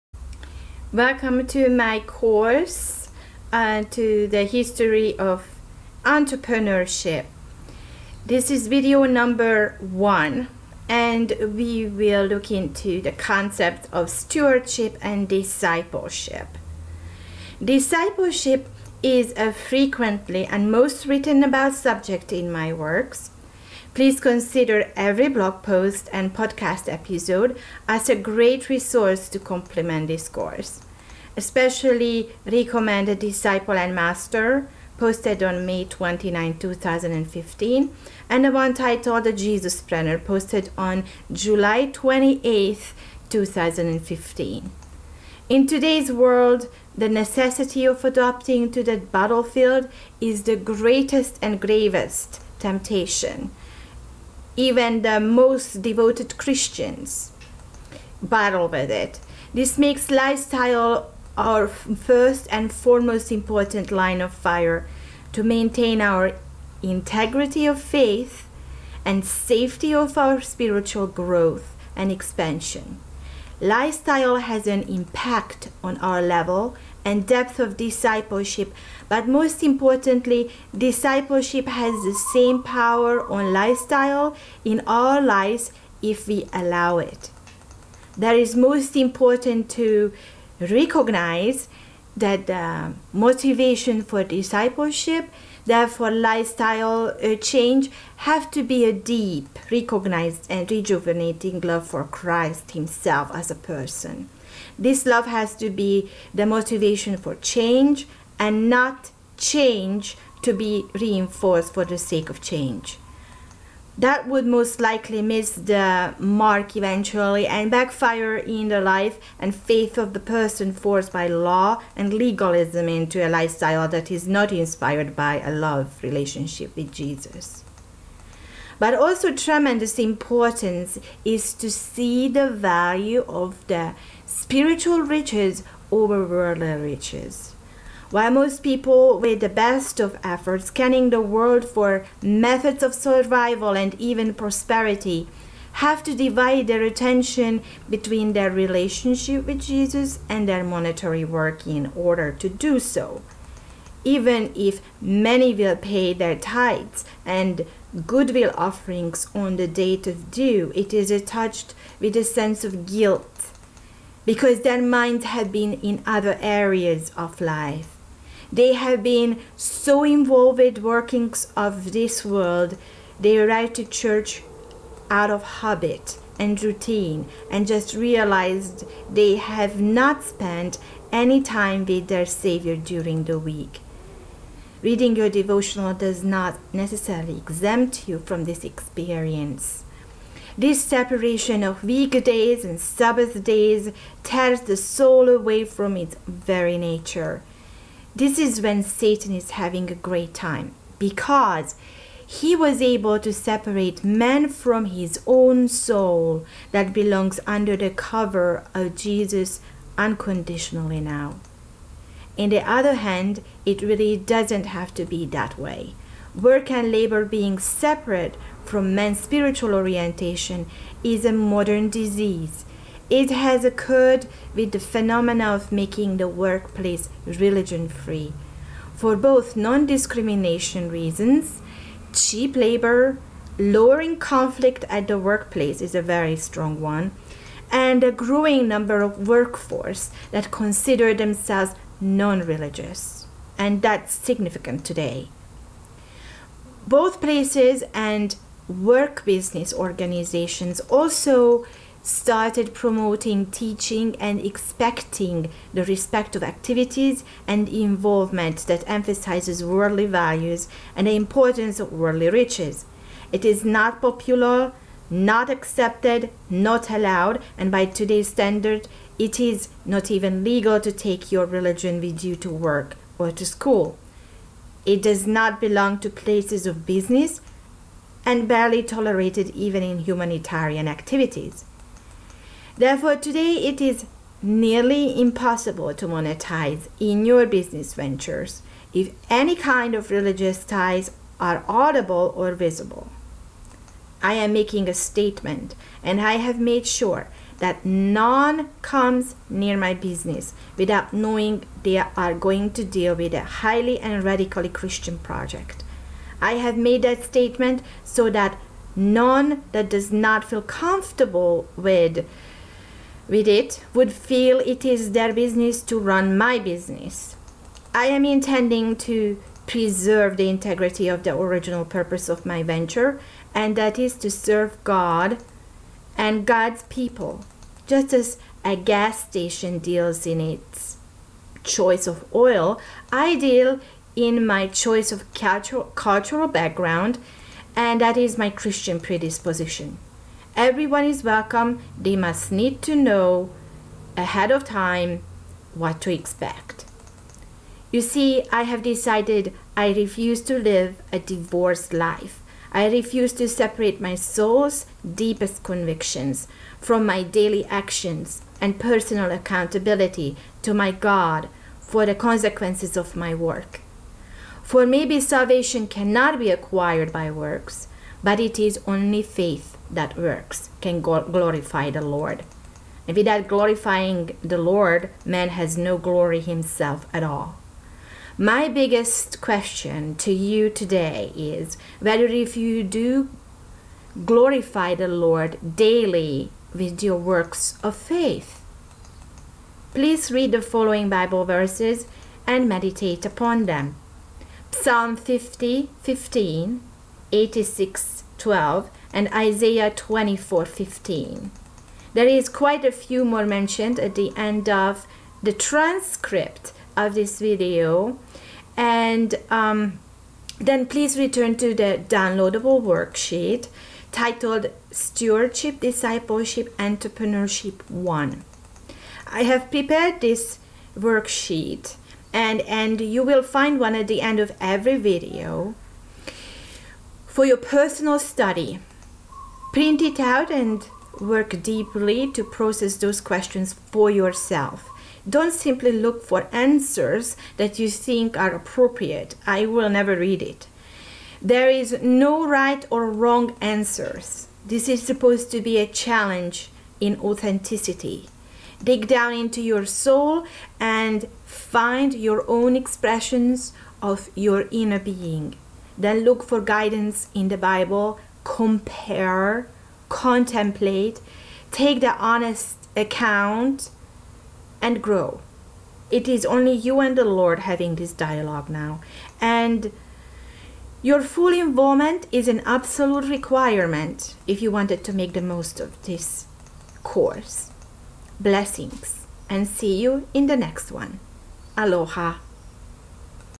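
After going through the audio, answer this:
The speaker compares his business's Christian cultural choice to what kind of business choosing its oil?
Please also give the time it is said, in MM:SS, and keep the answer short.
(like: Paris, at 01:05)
A gas station, at 05:28.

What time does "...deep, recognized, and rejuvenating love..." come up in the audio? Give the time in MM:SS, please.
01:38.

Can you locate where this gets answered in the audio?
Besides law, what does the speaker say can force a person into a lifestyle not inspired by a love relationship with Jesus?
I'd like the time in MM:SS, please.
02:02.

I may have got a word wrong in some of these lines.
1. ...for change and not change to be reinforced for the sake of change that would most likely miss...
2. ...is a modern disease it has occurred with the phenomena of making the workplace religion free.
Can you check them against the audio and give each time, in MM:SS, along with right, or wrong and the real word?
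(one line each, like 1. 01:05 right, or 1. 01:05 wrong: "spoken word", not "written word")
1. 01:47 right
2. 03:41 right.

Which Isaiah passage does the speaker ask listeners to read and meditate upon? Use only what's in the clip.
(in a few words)
Isaiah 24:15.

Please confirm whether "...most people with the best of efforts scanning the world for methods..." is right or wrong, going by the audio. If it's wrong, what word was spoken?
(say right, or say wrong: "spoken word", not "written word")
right.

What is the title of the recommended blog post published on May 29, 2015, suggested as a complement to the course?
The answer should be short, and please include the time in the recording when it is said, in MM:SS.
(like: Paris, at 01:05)
Disciple and Master, at 00:33.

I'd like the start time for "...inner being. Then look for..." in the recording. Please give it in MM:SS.
07:34.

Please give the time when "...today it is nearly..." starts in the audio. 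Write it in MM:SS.
04:43.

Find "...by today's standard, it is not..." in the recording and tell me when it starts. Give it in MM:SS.
04:27.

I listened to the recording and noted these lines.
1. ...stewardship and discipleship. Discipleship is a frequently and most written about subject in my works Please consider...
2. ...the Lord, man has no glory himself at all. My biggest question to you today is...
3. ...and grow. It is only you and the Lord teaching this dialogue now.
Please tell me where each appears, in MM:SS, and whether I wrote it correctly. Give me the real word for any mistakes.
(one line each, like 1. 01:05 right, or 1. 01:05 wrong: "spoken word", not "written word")
1. 00:14 right
2. 06:14 right
3. 07:44 wrong: "having", not "teaching".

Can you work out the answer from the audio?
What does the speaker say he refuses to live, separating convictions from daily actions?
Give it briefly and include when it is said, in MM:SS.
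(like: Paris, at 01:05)
A divorced life, at 05:51.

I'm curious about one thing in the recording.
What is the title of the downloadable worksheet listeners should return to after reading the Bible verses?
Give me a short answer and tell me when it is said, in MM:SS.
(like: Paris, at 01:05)
Stewardship, Discipleship, Entrepreneurship 1, at 06:54.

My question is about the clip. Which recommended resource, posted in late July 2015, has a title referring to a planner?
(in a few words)
The Jesus Planner.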